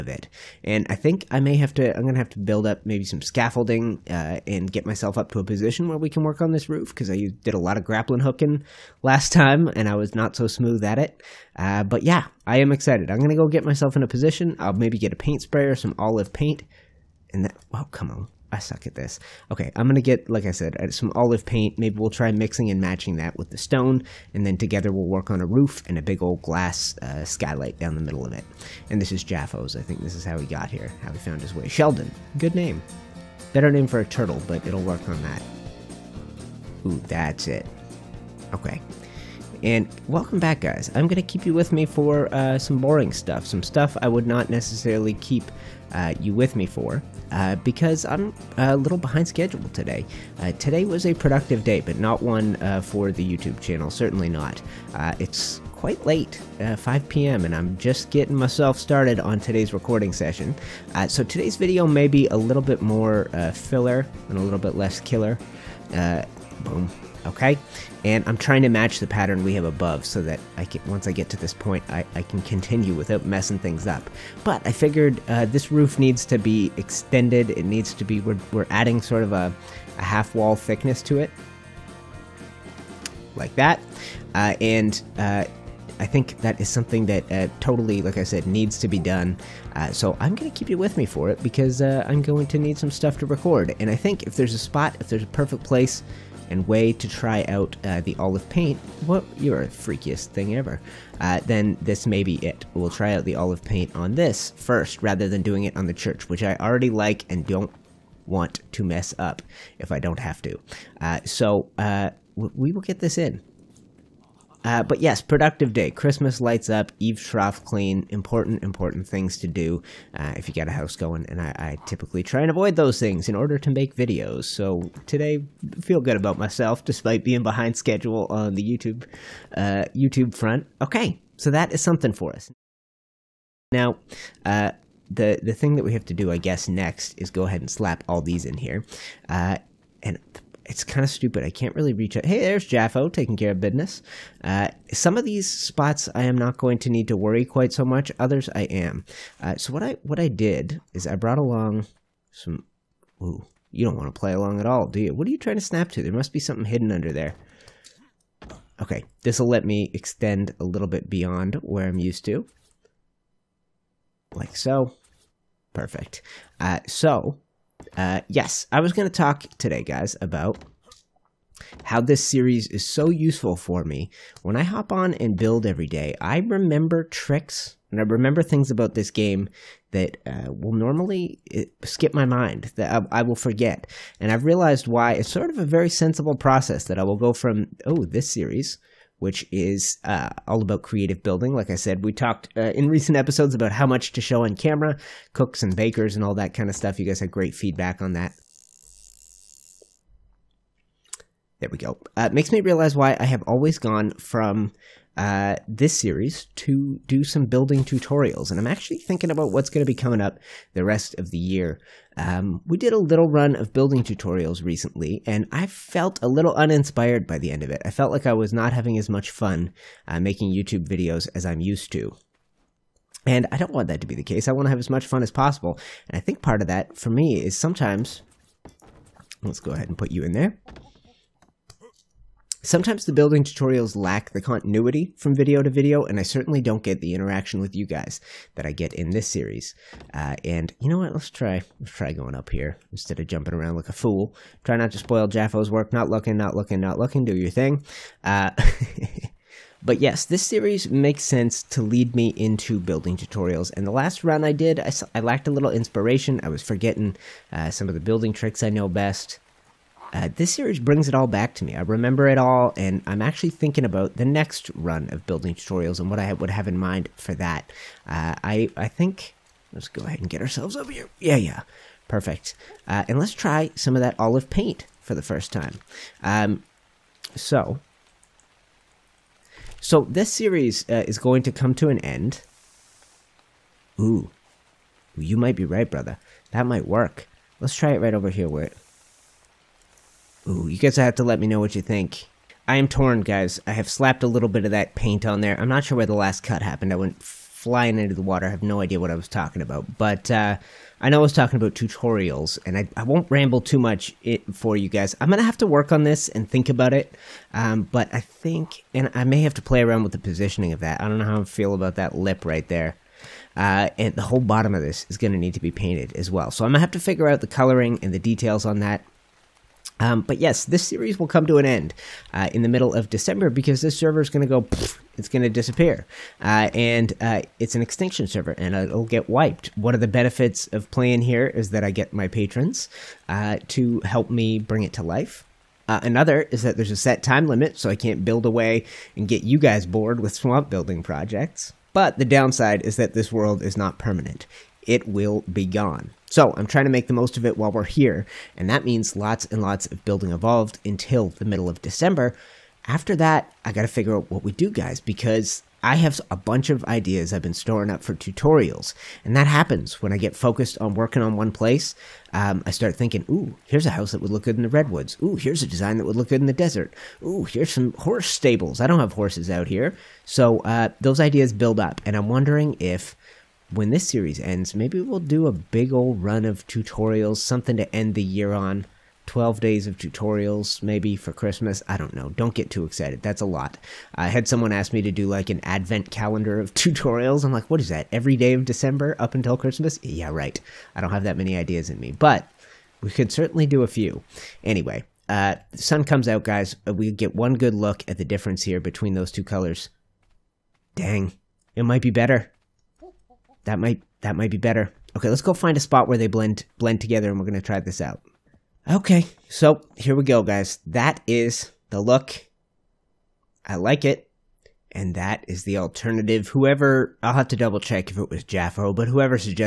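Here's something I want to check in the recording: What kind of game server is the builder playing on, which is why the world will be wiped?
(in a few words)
extinction server.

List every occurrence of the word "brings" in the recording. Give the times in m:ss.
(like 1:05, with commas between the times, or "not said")
4:20, 5:34.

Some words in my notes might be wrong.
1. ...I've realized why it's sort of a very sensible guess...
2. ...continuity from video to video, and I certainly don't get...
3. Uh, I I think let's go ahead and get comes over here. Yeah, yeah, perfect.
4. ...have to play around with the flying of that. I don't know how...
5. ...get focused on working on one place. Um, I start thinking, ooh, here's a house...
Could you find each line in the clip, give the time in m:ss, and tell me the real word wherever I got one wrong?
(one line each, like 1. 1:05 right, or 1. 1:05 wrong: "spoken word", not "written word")
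1. 3:04 wrong: "process", not "guess"
2. 3:54 right
3. 4:28 wrong: "ourselves", not "comes"
4. 5:09 wrong: "positioning", not "flying"
5. 6:00 right.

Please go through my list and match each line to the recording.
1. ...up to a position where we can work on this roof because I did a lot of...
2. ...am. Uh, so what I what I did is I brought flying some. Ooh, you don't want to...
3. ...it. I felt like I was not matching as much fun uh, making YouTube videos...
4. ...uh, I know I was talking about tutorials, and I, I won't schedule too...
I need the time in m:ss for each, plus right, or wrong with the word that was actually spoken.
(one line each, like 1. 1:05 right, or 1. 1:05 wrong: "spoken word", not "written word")
1. 0:05 right
2. 2:28 wrong: "along", not "flying"
3. 3:37 wrong: "having", not "matching"
4. 5:00 wrong: "ramble", not "schedule".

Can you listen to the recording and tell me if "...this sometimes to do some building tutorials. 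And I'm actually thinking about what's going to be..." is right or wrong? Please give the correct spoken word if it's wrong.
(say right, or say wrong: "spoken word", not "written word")
wrong: "series", not "sometimes".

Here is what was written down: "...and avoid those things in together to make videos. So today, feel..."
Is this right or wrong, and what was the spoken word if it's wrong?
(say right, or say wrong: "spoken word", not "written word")
wrong: "order", not "together".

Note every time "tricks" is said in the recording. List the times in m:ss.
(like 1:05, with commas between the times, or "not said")
2:57, 4:18.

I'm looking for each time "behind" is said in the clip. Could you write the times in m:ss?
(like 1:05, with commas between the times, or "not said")
0:48, 2:07.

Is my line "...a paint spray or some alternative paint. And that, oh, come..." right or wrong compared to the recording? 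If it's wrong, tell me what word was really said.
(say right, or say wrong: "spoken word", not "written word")
wrong: "olive", not "alternative".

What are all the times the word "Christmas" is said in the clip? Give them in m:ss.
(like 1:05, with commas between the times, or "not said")
1:55, 6:21, 6:29.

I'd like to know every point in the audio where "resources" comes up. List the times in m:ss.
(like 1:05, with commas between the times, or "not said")
not said.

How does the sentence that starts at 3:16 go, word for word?
You guys had great feedback on that.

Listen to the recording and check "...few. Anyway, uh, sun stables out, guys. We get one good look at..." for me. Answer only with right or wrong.
wrong.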